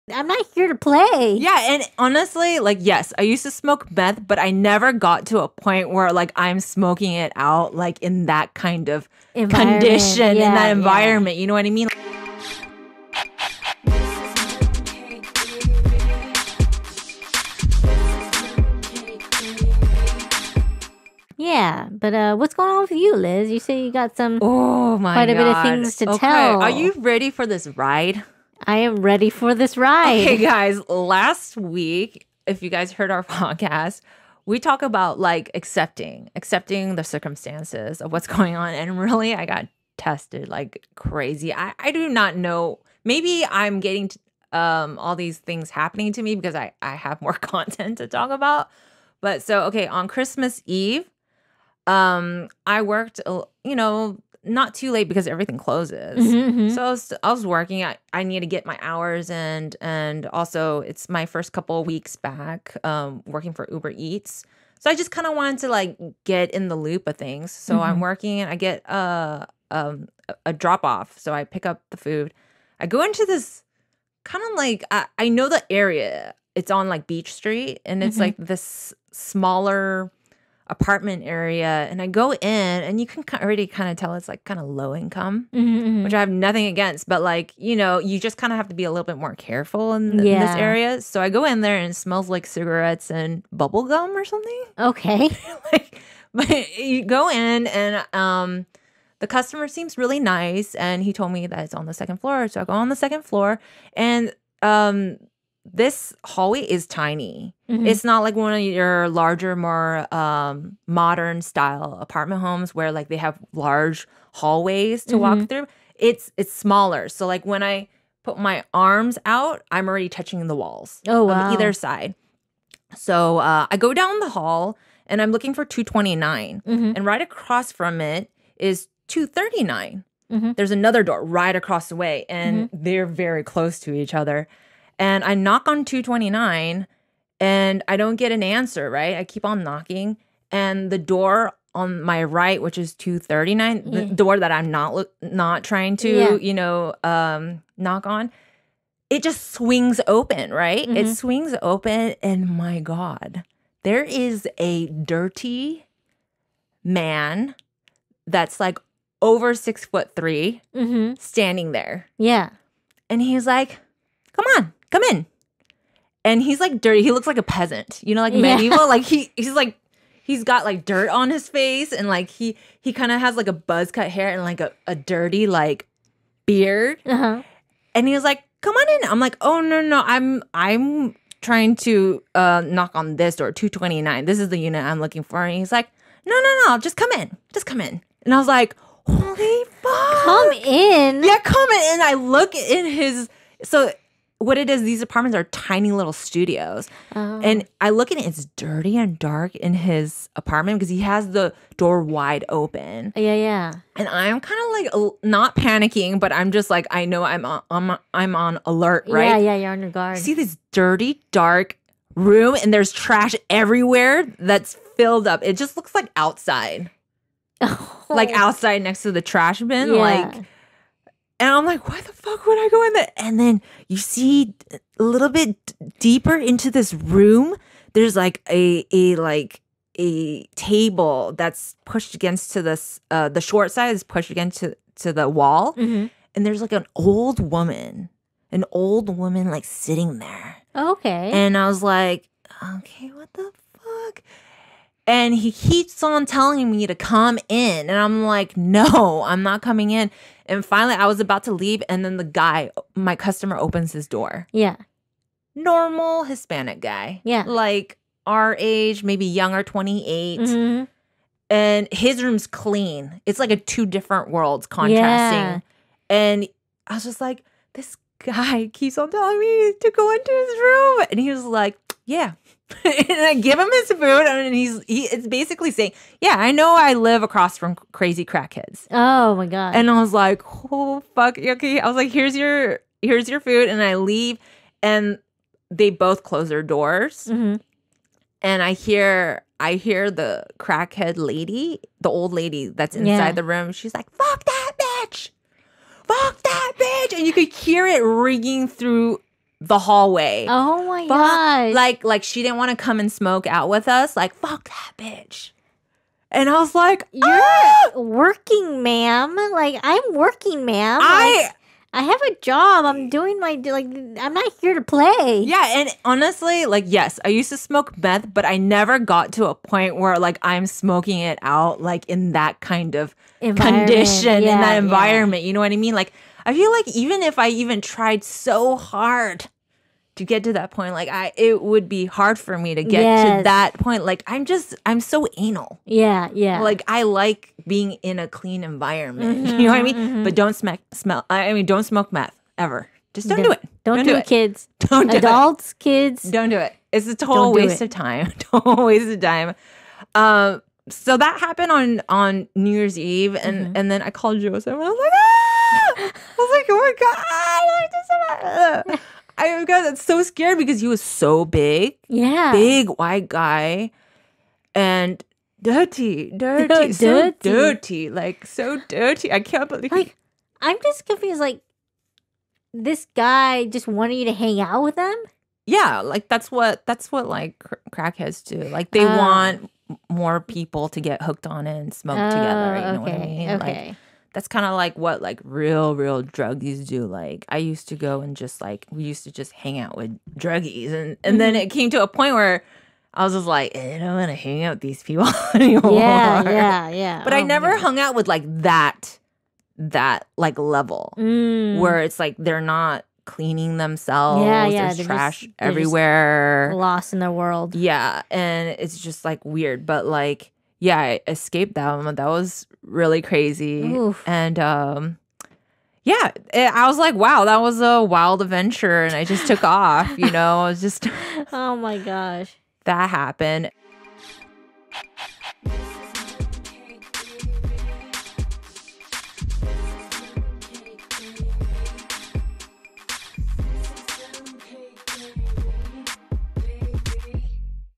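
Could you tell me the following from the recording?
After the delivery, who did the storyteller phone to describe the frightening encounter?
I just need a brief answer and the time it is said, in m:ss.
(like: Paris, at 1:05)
Joseph, at 5:54.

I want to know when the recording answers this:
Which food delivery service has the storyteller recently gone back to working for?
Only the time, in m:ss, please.
1:03.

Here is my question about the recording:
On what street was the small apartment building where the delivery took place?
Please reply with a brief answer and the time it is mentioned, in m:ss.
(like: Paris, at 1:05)
Beach Street, at 1:17.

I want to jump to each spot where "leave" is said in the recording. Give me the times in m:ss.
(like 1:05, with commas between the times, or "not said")
4:11, 4:43.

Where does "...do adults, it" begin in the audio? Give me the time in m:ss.
5:45.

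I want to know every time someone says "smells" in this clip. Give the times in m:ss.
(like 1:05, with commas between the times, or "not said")
1:32, 5:40.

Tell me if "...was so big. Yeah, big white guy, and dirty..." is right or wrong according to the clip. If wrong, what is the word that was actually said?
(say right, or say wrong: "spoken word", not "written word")
right.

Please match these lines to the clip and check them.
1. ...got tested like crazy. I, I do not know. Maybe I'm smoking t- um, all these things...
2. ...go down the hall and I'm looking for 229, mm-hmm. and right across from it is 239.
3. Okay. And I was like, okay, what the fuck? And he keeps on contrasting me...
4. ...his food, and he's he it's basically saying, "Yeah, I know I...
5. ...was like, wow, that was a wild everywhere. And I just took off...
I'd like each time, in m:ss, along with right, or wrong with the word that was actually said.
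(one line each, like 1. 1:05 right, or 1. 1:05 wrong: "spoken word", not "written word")
1. 0:39 wrong: "getting", not "smoking"
2. 2:03 right
3. 4:00 wrong: "telling", not "contrasting"
4. 4:33 right
5. 6:56 wrong: "adventure", not "everywhere".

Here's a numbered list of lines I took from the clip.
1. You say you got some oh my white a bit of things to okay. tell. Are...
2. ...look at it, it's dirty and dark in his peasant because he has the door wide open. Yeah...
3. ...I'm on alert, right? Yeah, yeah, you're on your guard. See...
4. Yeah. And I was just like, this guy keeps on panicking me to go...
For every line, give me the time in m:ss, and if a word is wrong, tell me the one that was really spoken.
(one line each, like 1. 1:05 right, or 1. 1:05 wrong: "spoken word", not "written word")
1. 0:23 wrong: "quite", not "white"
2. 3:17 wrong: "apartment", not "peasant"
3. 3:28 right
4. 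4:25 wrong: "telling", not "panicking".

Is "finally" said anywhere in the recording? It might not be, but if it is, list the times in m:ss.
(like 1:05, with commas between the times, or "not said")
4:10.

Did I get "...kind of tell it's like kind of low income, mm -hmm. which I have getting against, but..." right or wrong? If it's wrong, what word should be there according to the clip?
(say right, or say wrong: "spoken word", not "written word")
wrong: "nothing", not "getting".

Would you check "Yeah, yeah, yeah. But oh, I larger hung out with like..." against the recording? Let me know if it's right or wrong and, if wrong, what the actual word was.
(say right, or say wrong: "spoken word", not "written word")
wrong: "never", not "larger".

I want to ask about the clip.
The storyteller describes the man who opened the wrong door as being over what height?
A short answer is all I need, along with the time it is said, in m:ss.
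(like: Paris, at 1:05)
6 foot 3, at 2:39.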